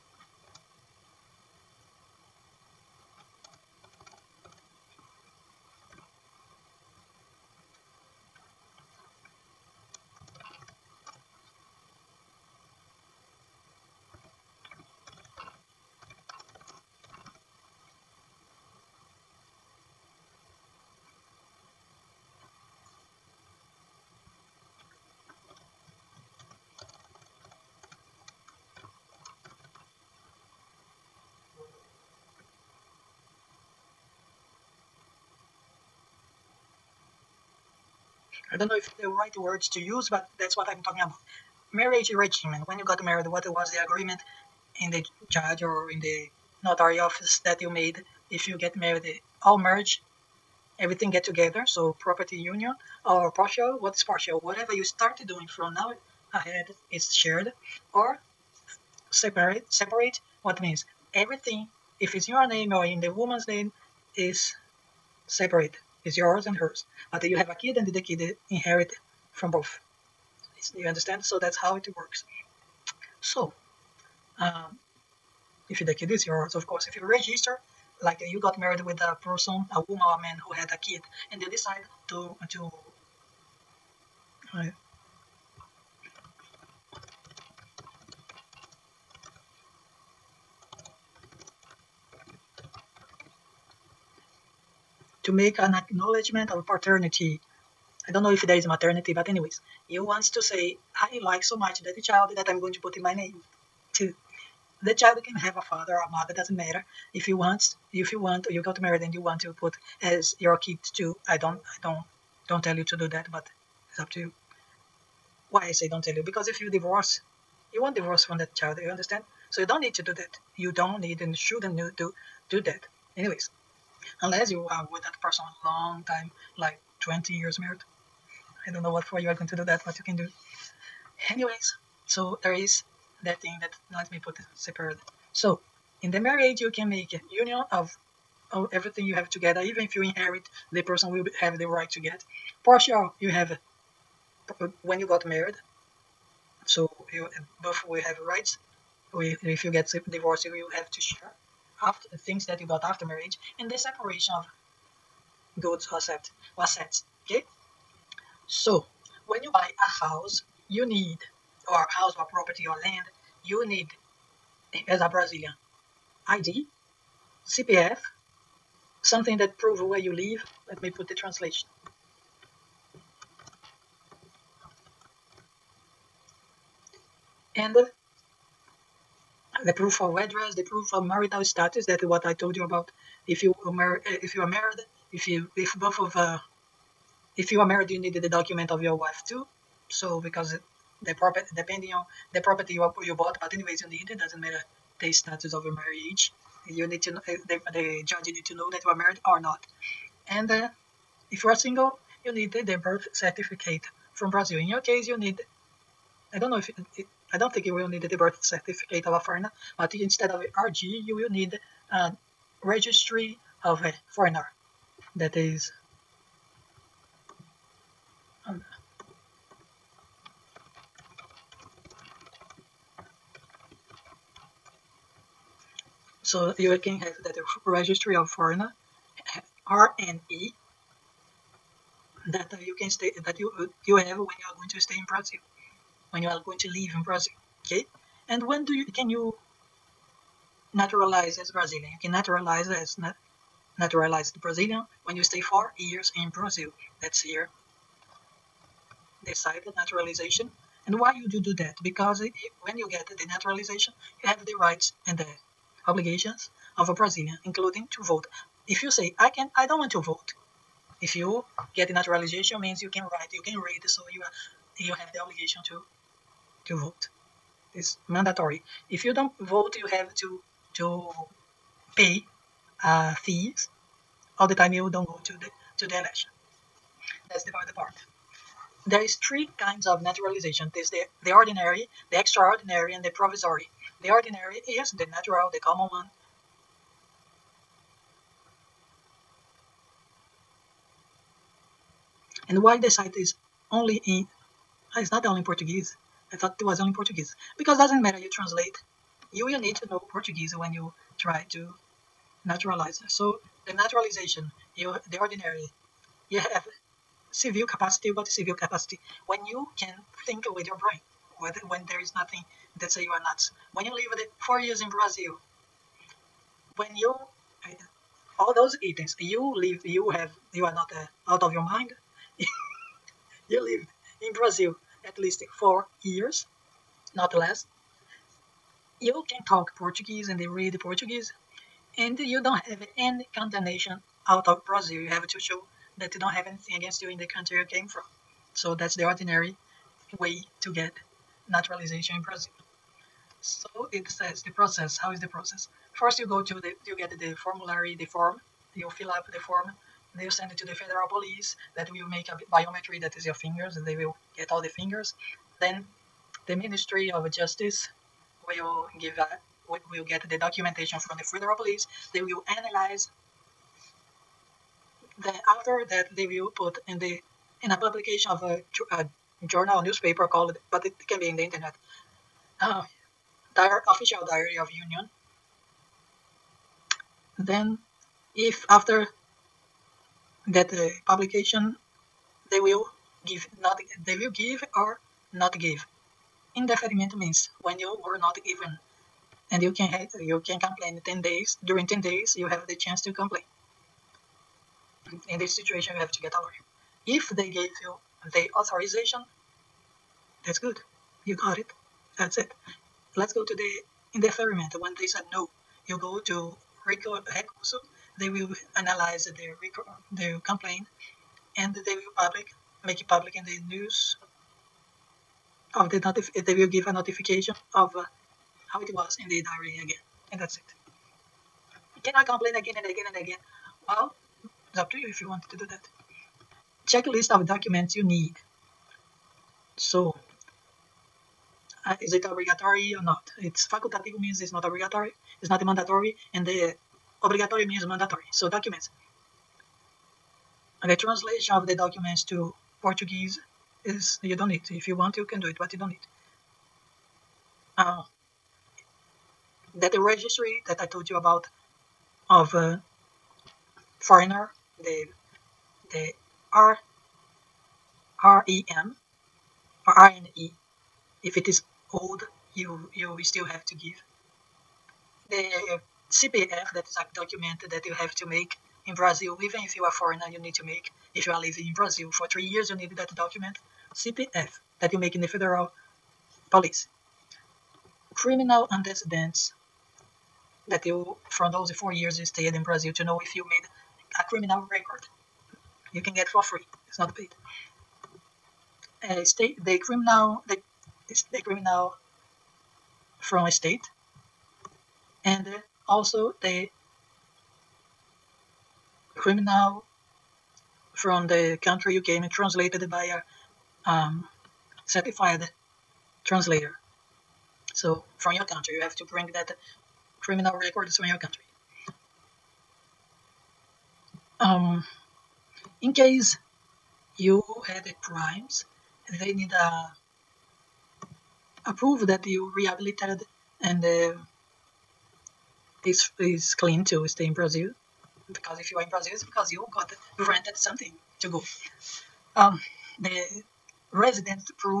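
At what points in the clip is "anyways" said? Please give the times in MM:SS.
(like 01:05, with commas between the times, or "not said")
01:39, 02:03, 02:11, 03:13.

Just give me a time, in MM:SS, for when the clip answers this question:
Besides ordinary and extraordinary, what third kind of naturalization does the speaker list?
04:43.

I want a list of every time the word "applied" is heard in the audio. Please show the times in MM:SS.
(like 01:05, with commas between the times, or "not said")
not said.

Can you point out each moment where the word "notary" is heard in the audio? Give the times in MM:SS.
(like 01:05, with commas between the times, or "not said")
00:46.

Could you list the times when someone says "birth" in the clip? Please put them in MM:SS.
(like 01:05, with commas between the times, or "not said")
03:22, 03:28.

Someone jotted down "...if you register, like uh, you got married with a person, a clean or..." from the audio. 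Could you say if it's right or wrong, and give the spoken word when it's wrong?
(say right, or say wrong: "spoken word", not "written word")
wrong: "woman", not "clean".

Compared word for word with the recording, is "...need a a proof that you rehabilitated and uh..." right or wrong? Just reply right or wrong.
right.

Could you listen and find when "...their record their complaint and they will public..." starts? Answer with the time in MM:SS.
06:49.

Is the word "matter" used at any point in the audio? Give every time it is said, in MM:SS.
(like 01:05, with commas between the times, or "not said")
01:46, 03:14, 04:58.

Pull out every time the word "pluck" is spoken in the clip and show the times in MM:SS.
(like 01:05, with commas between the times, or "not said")
not said.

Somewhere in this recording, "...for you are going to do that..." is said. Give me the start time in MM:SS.
02:09.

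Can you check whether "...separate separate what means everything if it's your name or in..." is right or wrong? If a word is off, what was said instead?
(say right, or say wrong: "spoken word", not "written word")
right.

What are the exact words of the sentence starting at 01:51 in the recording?
I don't, I don't don't tell you to do that, but it's up to you.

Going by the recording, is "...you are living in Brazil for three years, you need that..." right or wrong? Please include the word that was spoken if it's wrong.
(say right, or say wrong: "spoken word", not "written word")
right.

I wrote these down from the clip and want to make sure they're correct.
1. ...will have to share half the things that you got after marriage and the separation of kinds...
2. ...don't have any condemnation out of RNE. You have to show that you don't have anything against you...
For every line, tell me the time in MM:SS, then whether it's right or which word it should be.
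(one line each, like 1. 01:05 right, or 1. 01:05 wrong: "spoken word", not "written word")
1. 02:30 wrong: "goods", not "kinds"
2. 05:32 wrong: "Brazil", not "RNE".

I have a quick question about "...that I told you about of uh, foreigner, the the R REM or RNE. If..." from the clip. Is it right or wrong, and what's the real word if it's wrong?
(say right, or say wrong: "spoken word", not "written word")
right.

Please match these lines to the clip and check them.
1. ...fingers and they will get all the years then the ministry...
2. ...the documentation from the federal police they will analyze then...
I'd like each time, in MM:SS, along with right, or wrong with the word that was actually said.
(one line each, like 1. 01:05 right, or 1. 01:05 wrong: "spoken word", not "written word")
1. 05:53 wrong: "fingers", not "years"
2. 06:00 right.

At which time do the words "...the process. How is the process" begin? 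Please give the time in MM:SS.
05:44.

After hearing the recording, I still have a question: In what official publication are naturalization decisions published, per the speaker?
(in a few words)
Official Diary of Union.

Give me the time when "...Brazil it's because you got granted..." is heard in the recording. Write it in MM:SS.
08:48.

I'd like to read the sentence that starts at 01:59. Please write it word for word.
So you don't need to do that.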